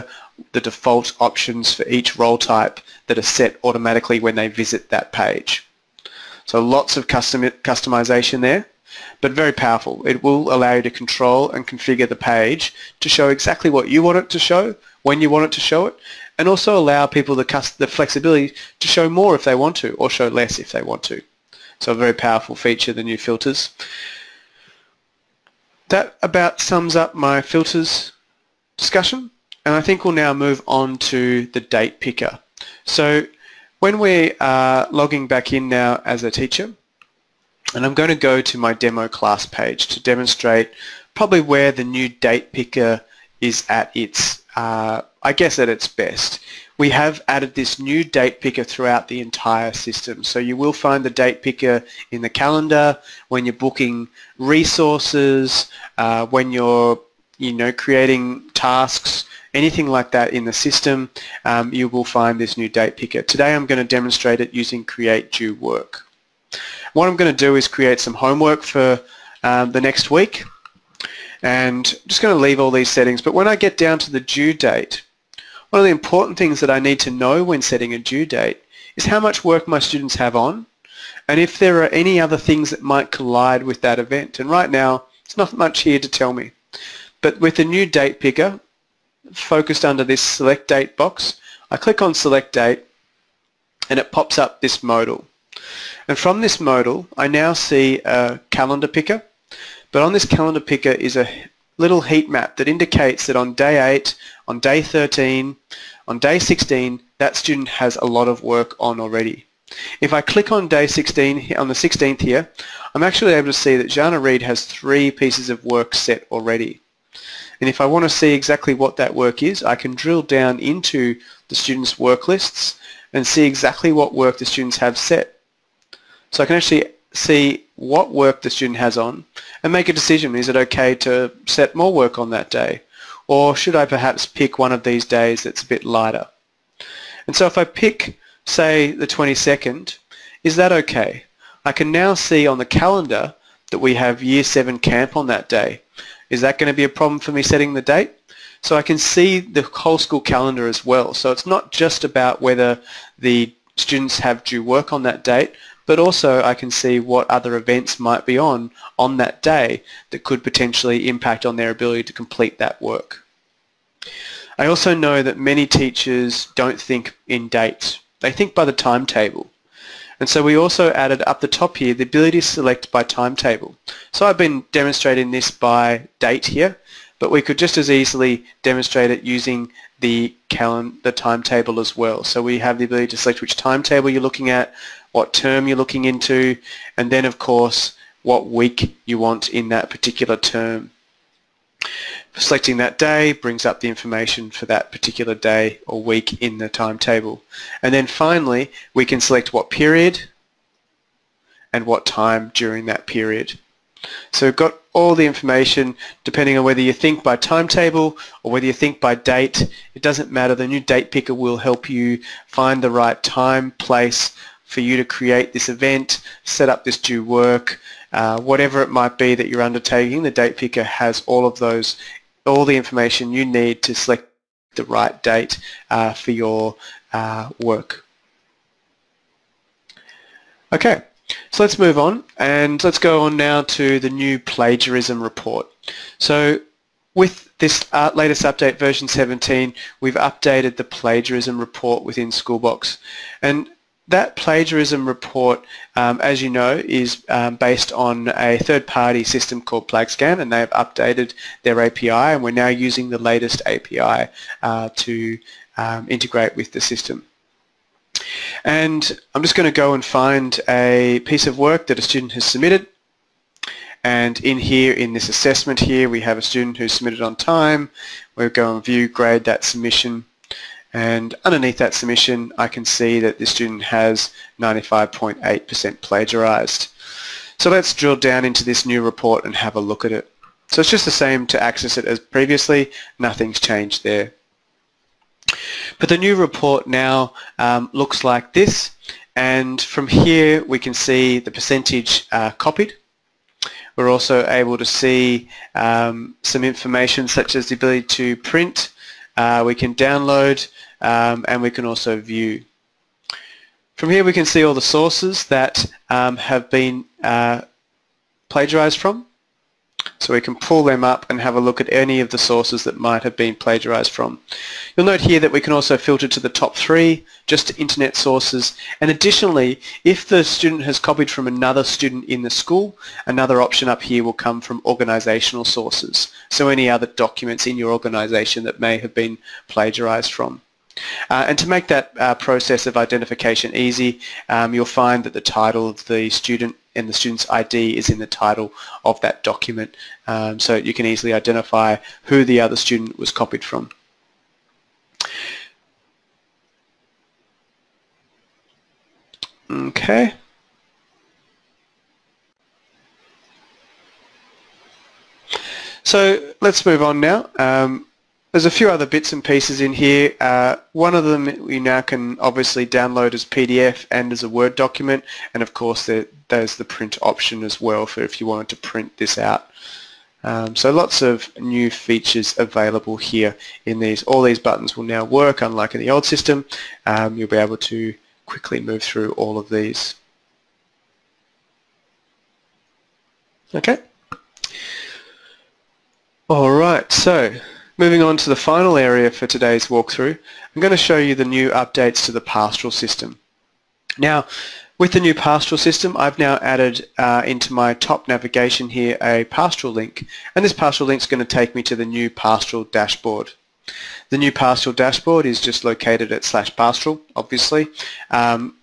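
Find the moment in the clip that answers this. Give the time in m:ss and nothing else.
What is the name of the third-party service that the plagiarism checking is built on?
4:09.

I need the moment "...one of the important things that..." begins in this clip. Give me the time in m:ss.
1:15.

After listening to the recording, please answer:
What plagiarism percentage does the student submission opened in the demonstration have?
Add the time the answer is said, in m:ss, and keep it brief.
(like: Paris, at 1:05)
95.8%, at 4:34.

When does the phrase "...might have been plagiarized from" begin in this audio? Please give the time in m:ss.
5:12.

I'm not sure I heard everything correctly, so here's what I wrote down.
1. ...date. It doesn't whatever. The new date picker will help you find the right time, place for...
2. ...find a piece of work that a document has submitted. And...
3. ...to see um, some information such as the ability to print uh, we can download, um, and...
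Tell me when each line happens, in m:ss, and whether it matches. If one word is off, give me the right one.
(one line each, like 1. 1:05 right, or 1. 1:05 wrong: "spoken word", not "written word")
1. 3:29 wrong: "matter", not "whatever"
2. 4:20 wrong: "student", not "document"
3. 4:54 right.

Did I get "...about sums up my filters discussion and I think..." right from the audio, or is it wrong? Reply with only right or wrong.
right.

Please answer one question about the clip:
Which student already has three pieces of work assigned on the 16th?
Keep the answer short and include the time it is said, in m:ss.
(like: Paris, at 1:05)
Jana Reed, at 1:53.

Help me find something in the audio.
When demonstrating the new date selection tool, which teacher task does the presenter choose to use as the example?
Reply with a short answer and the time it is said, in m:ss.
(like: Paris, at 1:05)
Create due work, at 1:04.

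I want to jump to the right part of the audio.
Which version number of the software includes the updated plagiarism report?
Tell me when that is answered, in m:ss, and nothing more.
3:58.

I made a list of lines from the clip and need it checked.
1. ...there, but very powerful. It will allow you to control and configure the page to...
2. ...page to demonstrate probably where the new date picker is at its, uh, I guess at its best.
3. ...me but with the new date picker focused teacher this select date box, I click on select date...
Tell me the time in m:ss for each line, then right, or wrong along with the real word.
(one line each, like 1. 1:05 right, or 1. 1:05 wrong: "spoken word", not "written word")
1. 0:08 right
2. 0:39 right
3. 1:26 wrong: "under", not "teacher".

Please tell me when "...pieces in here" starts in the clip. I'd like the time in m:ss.
5:59.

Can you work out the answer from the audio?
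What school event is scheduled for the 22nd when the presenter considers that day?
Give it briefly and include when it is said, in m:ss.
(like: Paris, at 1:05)
Year 7 camp, at 2:24.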